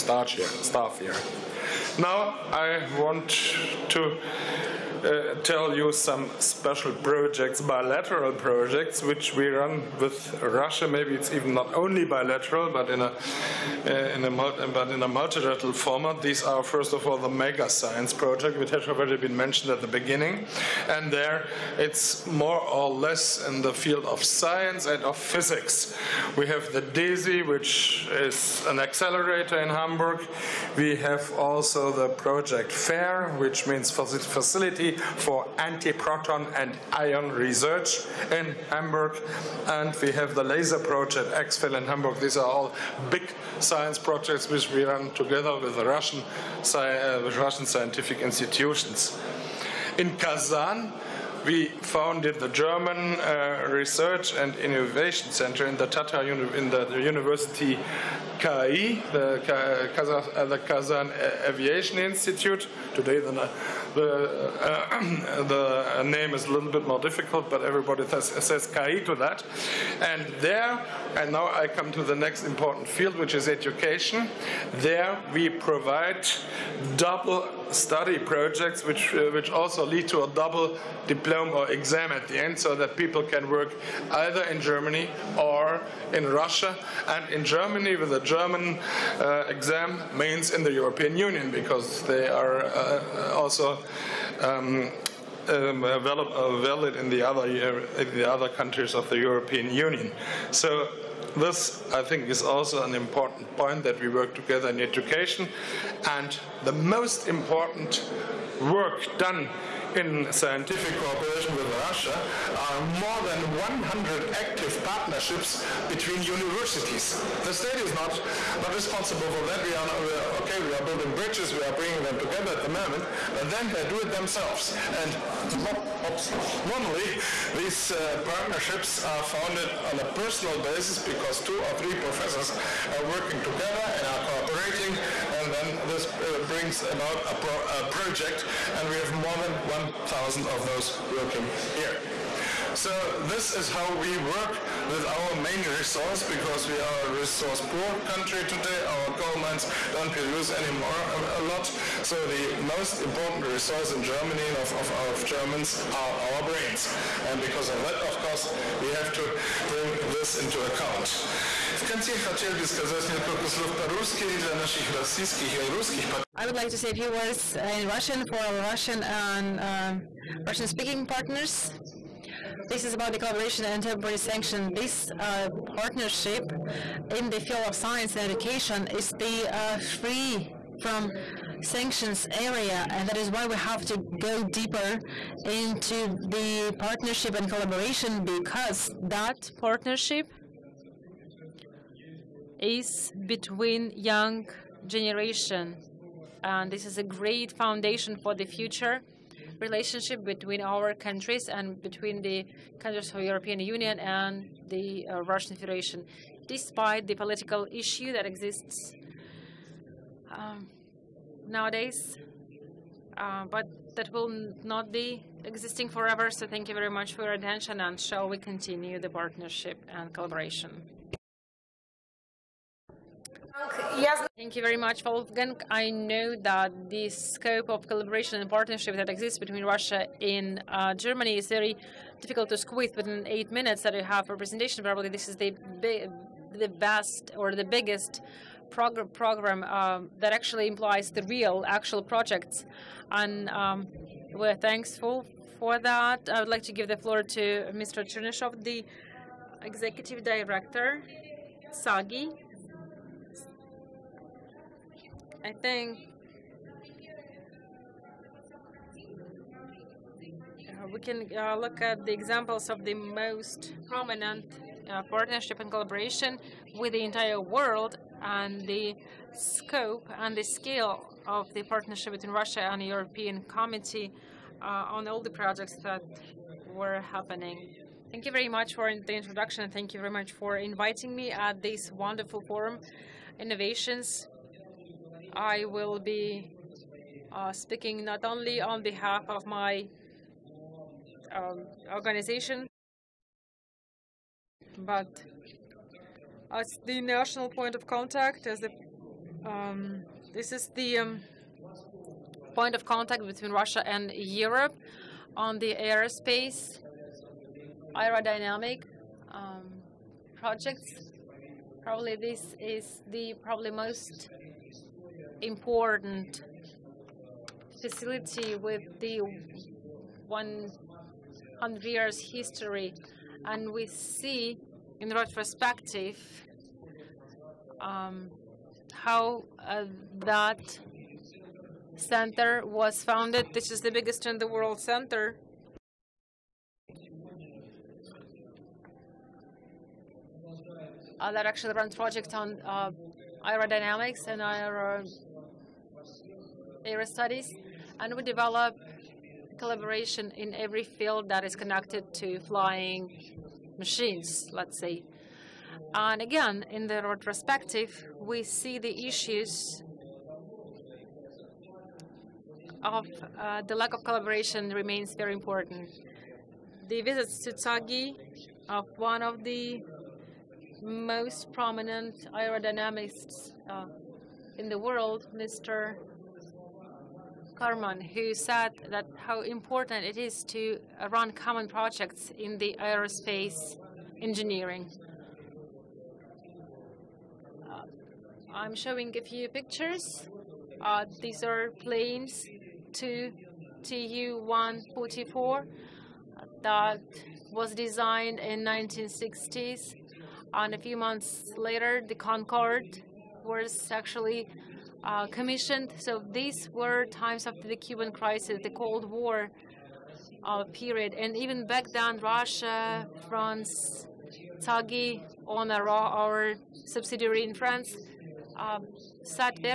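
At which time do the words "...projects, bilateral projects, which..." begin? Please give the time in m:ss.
0:06.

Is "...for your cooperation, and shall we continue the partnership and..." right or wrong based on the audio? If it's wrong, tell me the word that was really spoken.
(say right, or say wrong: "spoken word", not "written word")
wrong: "attention", not "cooperation".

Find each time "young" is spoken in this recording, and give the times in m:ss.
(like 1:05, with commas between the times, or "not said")
3:13.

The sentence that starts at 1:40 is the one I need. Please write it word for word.
So this, I think, is also an important point that we work together in education.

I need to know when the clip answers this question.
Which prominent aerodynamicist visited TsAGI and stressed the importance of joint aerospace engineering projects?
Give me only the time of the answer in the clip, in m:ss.
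6:17.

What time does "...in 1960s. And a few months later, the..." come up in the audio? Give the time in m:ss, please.
6:38.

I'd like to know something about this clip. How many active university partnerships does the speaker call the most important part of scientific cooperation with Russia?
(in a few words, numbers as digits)
more than 100.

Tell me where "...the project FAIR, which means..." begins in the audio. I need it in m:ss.
0:31.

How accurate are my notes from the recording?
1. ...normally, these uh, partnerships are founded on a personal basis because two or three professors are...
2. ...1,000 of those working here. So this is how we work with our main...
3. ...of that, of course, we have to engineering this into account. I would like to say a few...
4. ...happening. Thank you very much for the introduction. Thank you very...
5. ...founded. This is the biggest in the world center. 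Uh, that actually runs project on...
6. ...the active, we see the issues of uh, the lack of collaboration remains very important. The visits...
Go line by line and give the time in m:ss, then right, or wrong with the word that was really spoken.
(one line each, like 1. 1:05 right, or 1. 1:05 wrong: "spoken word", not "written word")
1. 2:06 right
2. 2:19 right
3. 2:37 wrong: "bring", not "engineering"
4. 4:37 right
5. 5:33 right
6. 5:56 wrong: "retrospective", not "active".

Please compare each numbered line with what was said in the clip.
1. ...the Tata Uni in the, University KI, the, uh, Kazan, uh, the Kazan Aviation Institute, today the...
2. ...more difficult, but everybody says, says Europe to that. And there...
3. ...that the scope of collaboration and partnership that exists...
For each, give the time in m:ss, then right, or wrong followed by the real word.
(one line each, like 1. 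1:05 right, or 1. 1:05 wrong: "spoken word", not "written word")
1. 0:55 right
2. 1:06 wrong: "Kai", not "Europe"
3. 3:46 right.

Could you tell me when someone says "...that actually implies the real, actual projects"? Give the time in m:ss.
4:00.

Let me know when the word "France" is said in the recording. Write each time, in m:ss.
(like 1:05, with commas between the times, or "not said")
6:53, 6:57.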